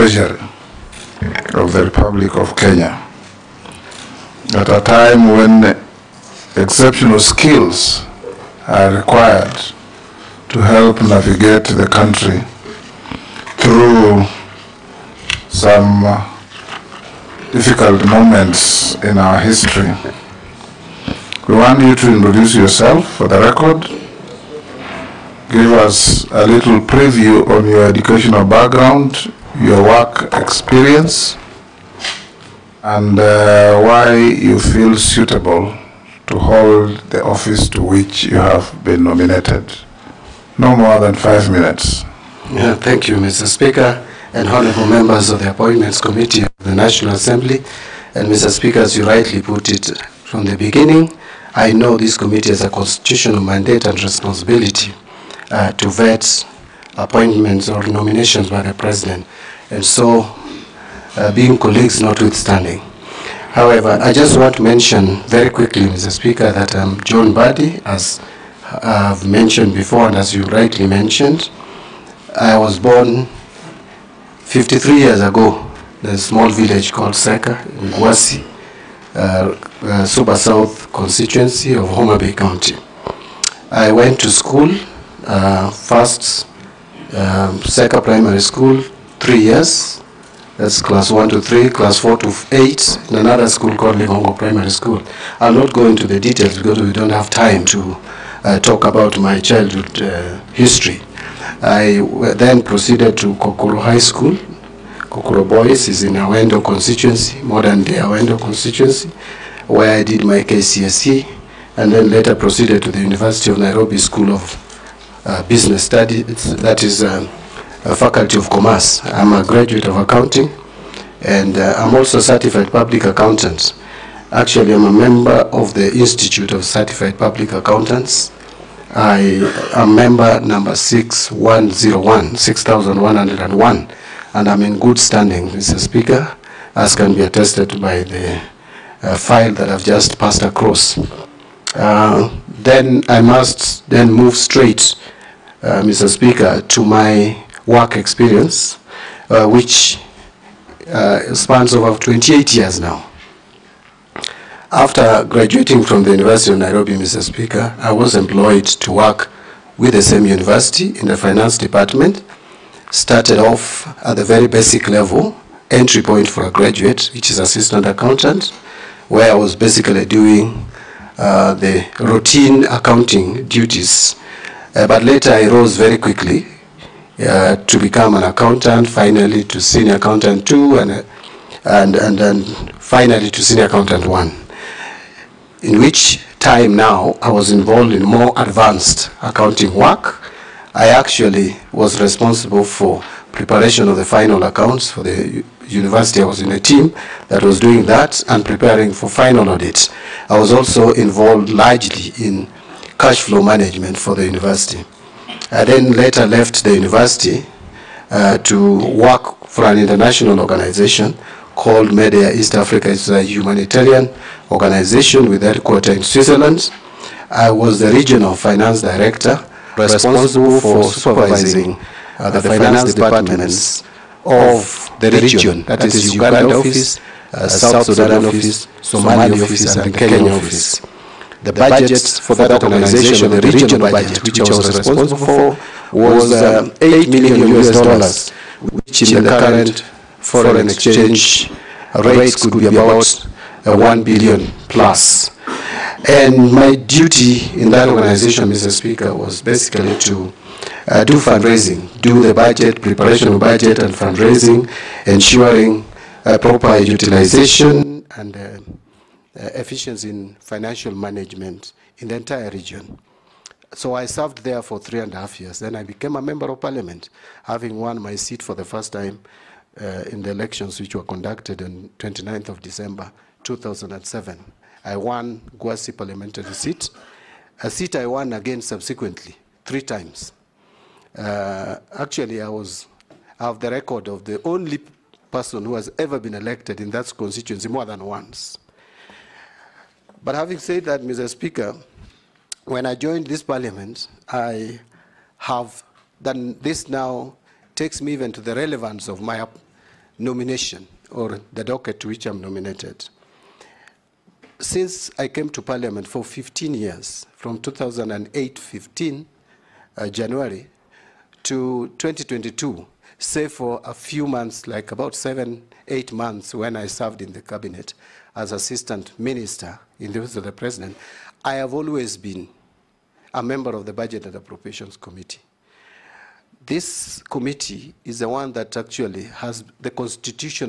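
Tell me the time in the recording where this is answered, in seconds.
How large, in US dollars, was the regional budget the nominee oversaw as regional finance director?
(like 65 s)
236 s.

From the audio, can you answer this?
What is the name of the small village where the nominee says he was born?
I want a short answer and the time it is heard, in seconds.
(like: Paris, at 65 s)
Seka, at 77 s.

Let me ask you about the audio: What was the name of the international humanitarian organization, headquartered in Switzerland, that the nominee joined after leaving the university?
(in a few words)
Medair East Africa.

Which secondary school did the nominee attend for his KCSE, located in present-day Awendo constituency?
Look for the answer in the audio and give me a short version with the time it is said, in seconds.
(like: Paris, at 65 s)
Kokoro High School, at 103 s.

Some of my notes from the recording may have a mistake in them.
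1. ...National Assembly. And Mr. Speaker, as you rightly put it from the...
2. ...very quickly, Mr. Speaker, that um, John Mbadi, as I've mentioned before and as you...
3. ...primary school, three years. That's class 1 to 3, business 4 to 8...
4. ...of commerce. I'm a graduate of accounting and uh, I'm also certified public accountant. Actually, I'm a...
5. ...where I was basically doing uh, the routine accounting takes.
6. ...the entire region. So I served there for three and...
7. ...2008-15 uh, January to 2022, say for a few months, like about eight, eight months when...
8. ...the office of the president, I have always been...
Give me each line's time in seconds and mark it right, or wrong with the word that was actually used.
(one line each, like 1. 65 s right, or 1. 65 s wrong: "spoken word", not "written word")
1. 46 s right
2. 65 s right
3. 88 s wrong: "class", not "business"
4. 118 s right
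5. 169 s wrong: "duties", not "takes"
6. 262 s right
7. 307 s wrong: "seven", not "eight"
8. 320 s right.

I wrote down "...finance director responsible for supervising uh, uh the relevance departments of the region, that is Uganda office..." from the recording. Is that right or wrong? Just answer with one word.
wrong.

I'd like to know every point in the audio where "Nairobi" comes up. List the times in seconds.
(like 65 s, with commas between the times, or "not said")
113 s, 156 s.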